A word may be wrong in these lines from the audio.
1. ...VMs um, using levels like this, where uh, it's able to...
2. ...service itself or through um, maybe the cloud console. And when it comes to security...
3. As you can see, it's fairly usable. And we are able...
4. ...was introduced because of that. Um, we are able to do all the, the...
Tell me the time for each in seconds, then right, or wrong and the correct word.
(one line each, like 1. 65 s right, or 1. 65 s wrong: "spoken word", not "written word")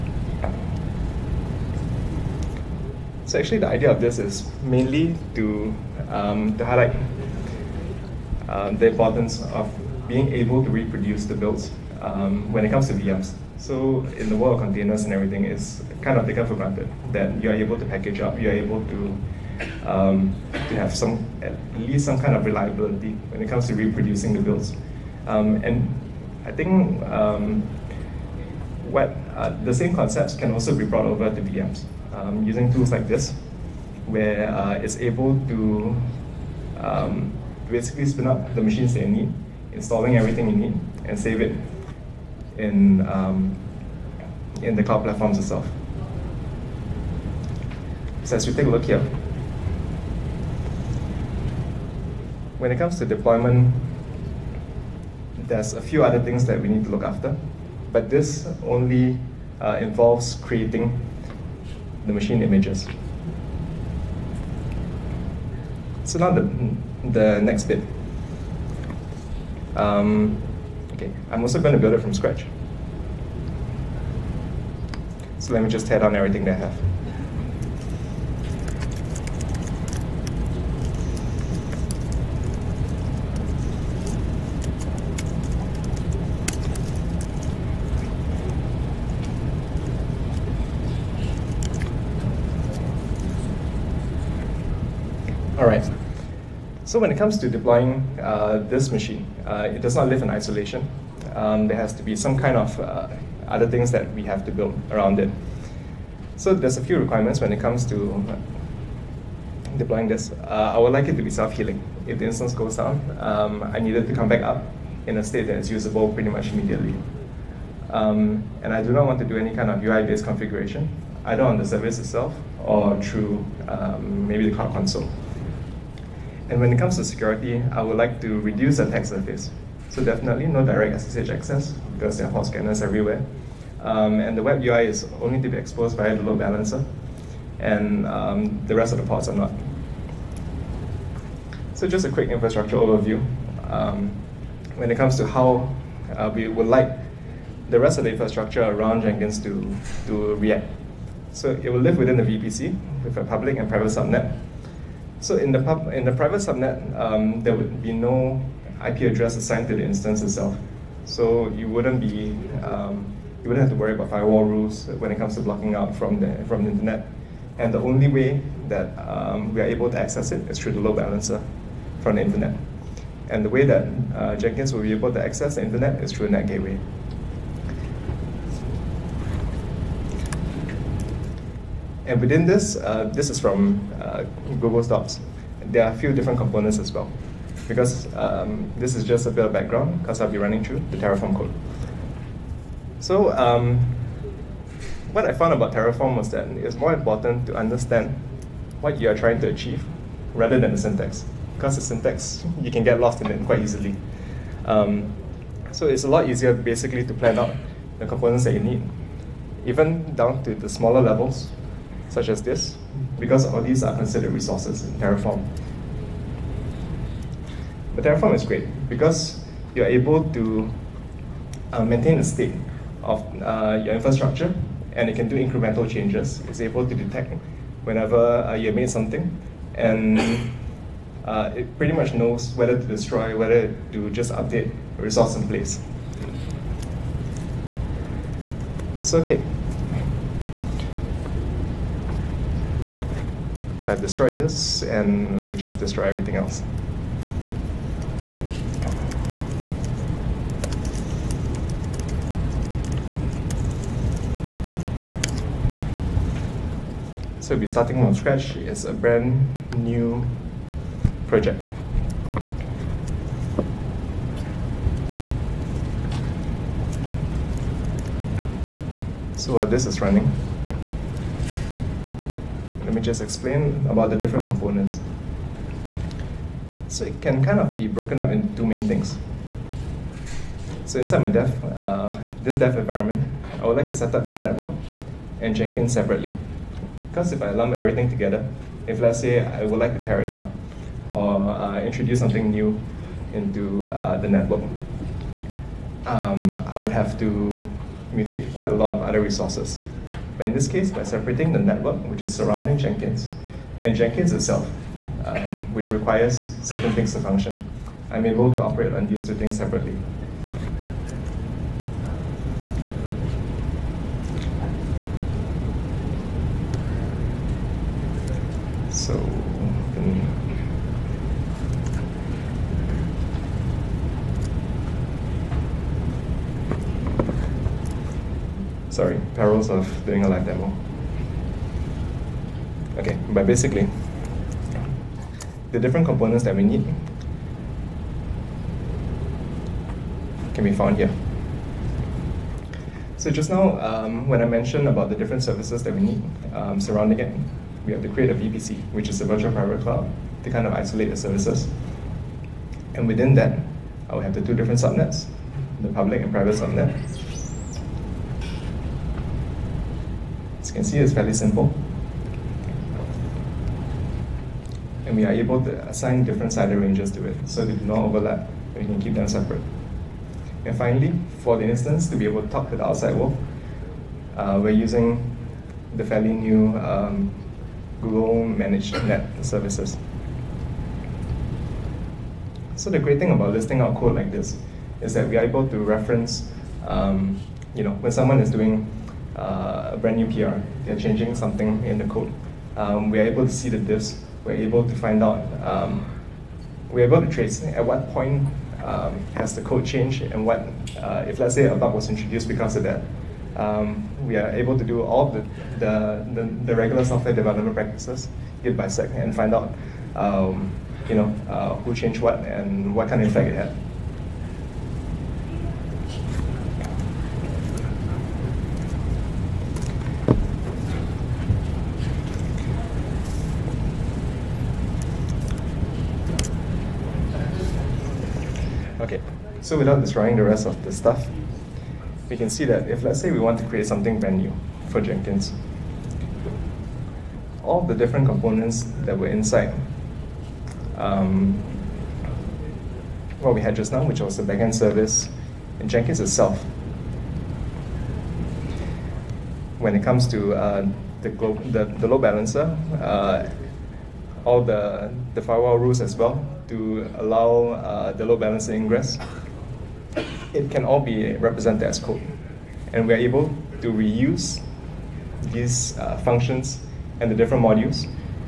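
1. 31 s wrong: "tools", not "levels"
2. 121 s right
3. 360 s wrong: "simple", not "usable"
4. 401 s right.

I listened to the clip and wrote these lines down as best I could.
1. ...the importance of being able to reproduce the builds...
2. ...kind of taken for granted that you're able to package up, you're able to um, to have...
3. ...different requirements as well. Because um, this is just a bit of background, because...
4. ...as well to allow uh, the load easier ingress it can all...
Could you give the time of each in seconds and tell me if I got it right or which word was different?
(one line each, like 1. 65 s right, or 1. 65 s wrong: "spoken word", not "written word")
1. 8 s right
2. 16 s right
3. 186 s wrong: "components", not "requirements"
4. 456 s wrong: "balancer", not "easier".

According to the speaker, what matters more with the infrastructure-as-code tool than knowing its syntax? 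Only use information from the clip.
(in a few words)
What you are trying to achieve.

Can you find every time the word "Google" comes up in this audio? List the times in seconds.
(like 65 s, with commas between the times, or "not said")
184 s, 378 s.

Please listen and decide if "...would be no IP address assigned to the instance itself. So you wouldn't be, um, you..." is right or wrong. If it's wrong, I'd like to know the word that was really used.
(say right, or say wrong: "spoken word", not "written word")
right.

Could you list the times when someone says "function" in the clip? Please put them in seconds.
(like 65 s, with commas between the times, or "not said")
307 s, 466 s.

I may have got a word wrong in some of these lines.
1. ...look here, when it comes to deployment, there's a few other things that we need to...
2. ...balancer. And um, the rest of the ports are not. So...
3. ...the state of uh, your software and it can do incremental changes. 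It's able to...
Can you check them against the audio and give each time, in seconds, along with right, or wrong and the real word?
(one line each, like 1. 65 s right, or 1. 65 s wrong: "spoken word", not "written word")
1. 48 s right
2. 136 s right
3. 222 s wrong: "infrastructure", not "software".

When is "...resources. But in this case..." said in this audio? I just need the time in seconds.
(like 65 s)
299 s.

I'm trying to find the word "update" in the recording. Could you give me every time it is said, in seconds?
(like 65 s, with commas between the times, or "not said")
234 s.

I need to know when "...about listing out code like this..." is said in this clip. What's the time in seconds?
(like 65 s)
383 s.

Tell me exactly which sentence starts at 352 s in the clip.
And within that, I will have the two different subnets, the public and private subnet.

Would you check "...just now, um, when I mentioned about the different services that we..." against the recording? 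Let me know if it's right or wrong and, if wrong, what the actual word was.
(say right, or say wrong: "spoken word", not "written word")
right.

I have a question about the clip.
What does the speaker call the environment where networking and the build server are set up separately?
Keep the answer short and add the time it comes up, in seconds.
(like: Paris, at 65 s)
Dev environment, at 282 s.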